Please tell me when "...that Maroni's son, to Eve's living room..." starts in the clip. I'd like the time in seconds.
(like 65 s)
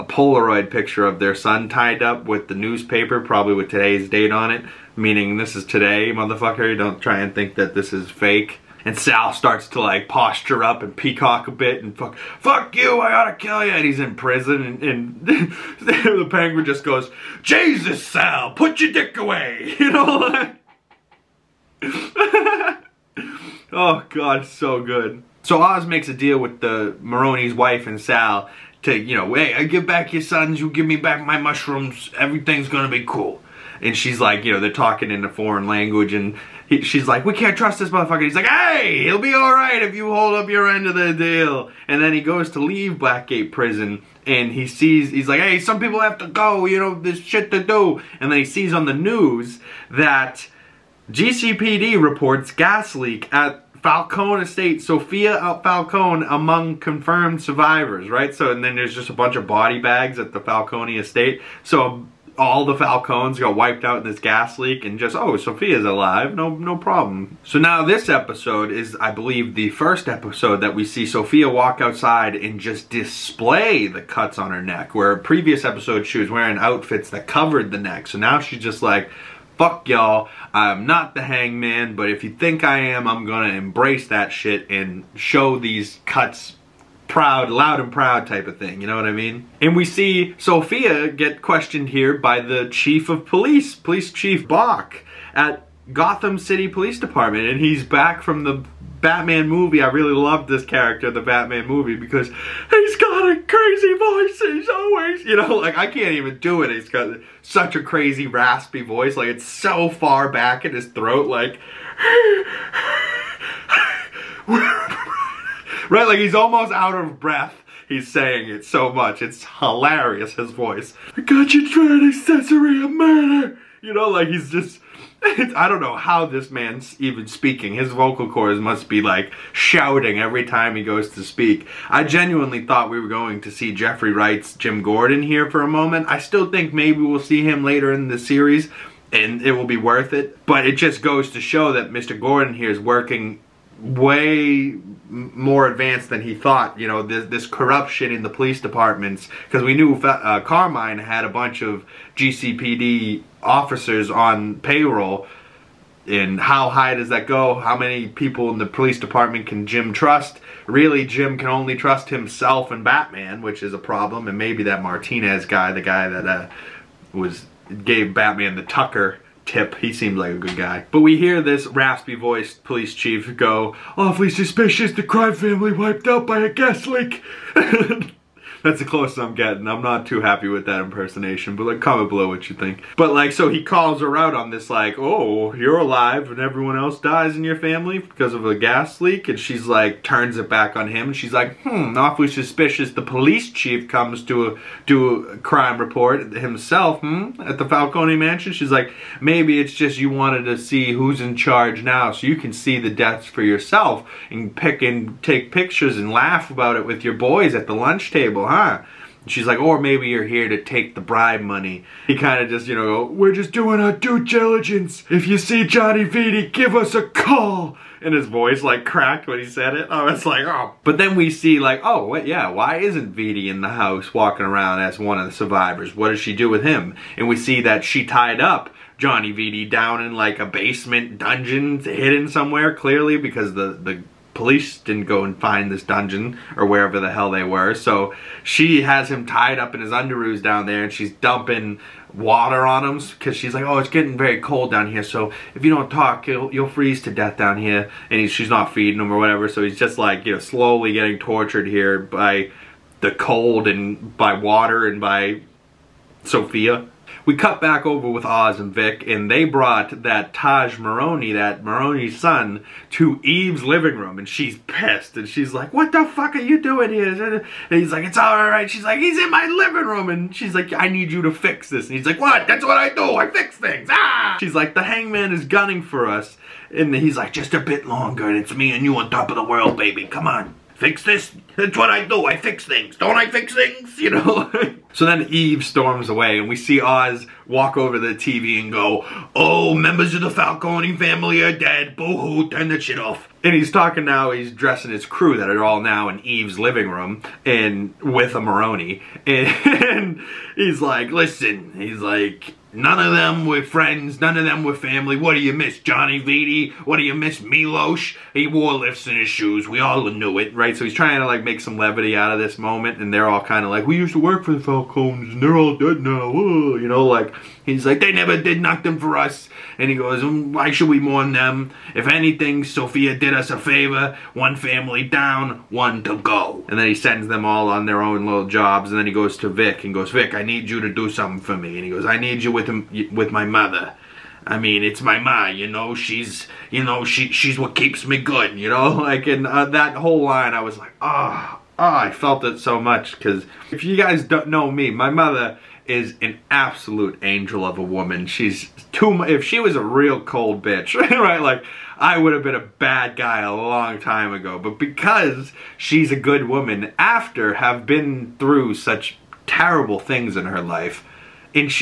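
261 s.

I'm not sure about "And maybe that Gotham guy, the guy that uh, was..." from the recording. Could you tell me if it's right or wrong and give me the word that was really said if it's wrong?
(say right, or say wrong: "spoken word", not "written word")
wrong: "Martinez", not "Gotham".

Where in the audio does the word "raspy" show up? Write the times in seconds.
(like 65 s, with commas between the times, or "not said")
108 s, 171 s.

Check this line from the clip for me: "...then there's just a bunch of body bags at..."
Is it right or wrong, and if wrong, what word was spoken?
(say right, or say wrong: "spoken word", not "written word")
right.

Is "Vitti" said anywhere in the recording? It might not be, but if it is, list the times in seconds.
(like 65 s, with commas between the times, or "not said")
216 s, 223 s, 229 s, 306 s.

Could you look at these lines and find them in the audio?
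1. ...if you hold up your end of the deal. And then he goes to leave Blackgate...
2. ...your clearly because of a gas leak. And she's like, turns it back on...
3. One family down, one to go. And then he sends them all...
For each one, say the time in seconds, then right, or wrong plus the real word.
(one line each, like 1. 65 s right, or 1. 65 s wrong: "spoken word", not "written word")
1. 39 s right
2. 187 s wrong: "family", not "clearly"
3. 324 s right.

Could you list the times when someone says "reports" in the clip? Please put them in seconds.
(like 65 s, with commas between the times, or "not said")
52 s, 195 s.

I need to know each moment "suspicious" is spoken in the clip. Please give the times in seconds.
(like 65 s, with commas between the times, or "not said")
174 s, 192 s.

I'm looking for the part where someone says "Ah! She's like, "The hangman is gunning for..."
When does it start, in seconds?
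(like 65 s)
273 s.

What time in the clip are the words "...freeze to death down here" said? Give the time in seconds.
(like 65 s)
246 s.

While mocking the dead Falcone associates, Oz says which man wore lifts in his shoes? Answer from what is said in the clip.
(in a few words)
Milosh.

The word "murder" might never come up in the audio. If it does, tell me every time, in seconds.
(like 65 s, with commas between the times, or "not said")
122 s.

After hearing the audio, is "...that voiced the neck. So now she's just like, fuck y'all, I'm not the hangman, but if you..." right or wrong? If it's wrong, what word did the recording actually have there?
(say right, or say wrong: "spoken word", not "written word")
wrong: "covered", not "voiced".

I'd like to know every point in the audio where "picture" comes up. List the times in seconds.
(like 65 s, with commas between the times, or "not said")
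0 s, 205 s.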